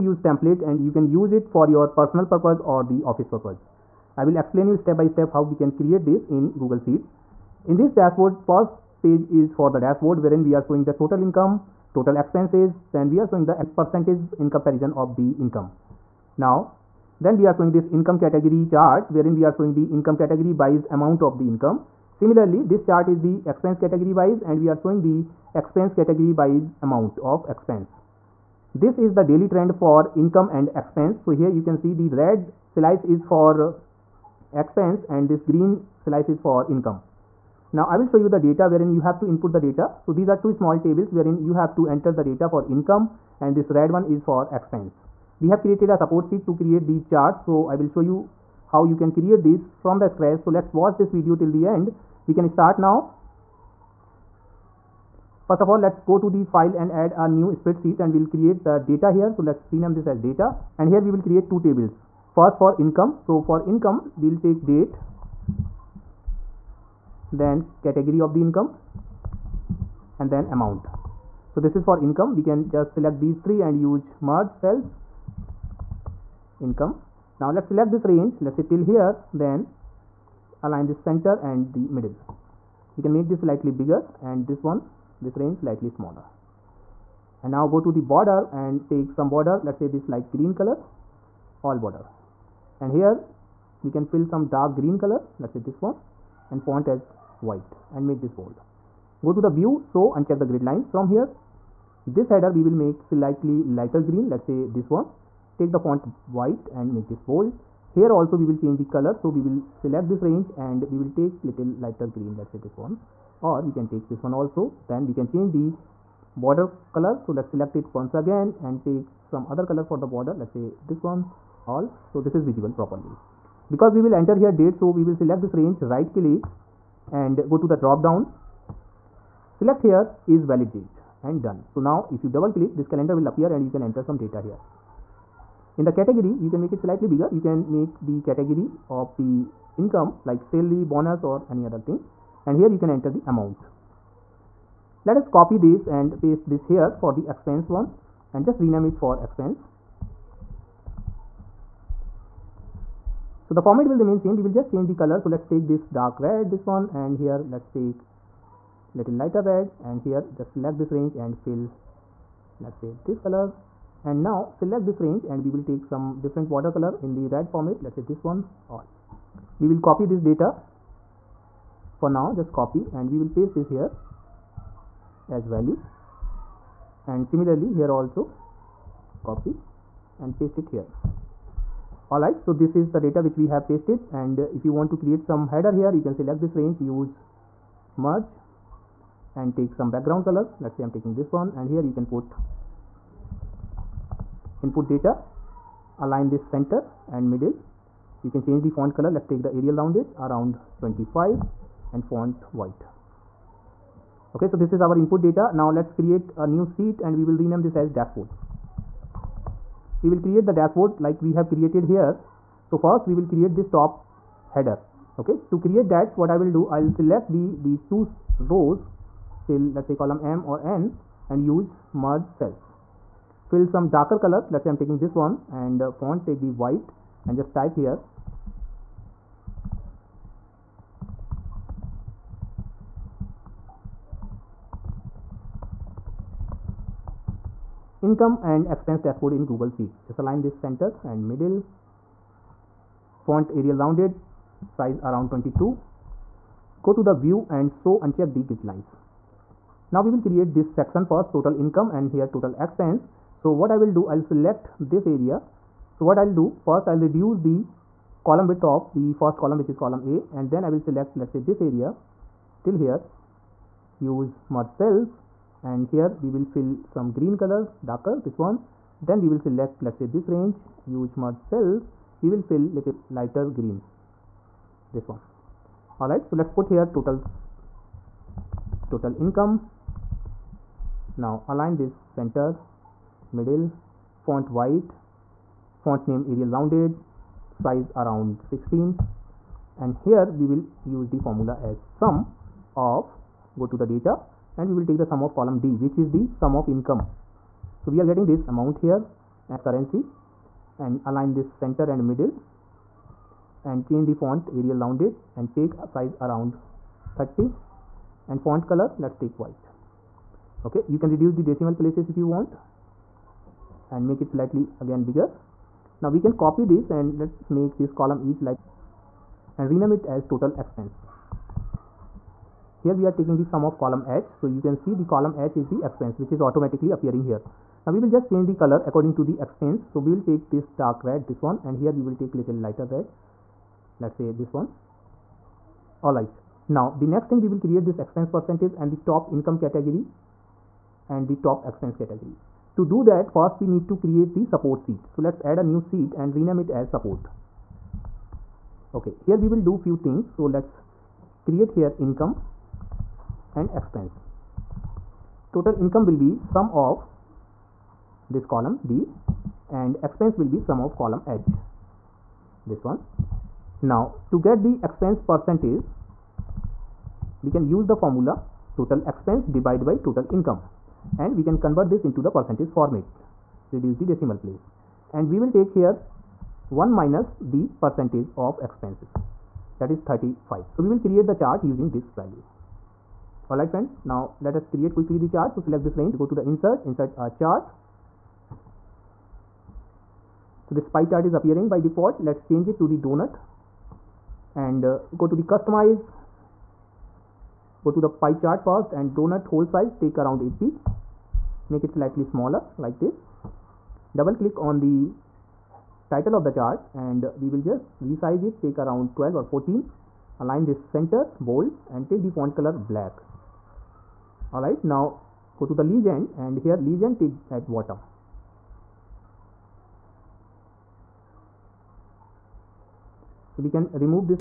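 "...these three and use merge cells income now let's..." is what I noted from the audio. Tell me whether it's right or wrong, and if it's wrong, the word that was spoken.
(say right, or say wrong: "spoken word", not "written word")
right.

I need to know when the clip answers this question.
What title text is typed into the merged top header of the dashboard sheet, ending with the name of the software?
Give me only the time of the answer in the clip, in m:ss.
3:58.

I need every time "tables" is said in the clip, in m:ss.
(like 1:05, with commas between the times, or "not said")
0:40, 1:01.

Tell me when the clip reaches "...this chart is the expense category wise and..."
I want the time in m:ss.
0:22.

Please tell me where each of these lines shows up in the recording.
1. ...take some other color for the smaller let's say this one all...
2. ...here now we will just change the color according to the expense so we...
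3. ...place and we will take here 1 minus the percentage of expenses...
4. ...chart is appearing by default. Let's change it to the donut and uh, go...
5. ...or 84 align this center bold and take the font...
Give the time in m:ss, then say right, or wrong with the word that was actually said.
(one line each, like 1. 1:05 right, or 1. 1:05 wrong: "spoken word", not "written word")
1. 1:58 wrong: "border", not "smaller"
2. 5:27 right
3. 6:14 right
4. 6:31 right
5. 6:49 wrong: "14", not "84".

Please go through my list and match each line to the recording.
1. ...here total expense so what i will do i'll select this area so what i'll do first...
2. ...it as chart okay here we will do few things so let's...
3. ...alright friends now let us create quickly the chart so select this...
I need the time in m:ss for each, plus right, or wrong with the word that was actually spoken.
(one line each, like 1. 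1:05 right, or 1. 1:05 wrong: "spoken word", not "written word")
1. 4:12 right
2. 5:46 wrong: "support", not "chart"
3. 6:23 right.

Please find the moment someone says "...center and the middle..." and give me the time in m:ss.
1:20.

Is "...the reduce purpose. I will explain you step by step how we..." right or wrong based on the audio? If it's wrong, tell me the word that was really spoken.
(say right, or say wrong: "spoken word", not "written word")
wrong: "office", not "reduce".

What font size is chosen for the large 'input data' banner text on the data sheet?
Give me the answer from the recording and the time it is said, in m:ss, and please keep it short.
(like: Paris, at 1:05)
25, at 3:20.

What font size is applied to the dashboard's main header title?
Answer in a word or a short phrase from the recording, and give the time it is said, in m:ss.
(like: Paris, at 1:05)
22, at 4:04.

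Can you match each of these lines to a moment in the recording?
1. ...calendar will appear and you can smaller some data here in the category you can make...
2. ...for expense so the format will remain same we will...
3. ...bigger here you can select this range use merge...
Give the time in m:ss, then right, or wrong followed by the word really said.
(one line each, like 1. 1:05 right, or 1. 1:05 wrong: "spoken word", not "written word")
1. 2:12 wrong: "enter", not "smaller"
2. 2:28 right
3. 3:05 wrong: "header", not "bigger".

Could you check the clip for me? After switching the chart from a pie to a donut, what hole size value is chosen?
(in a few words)
80.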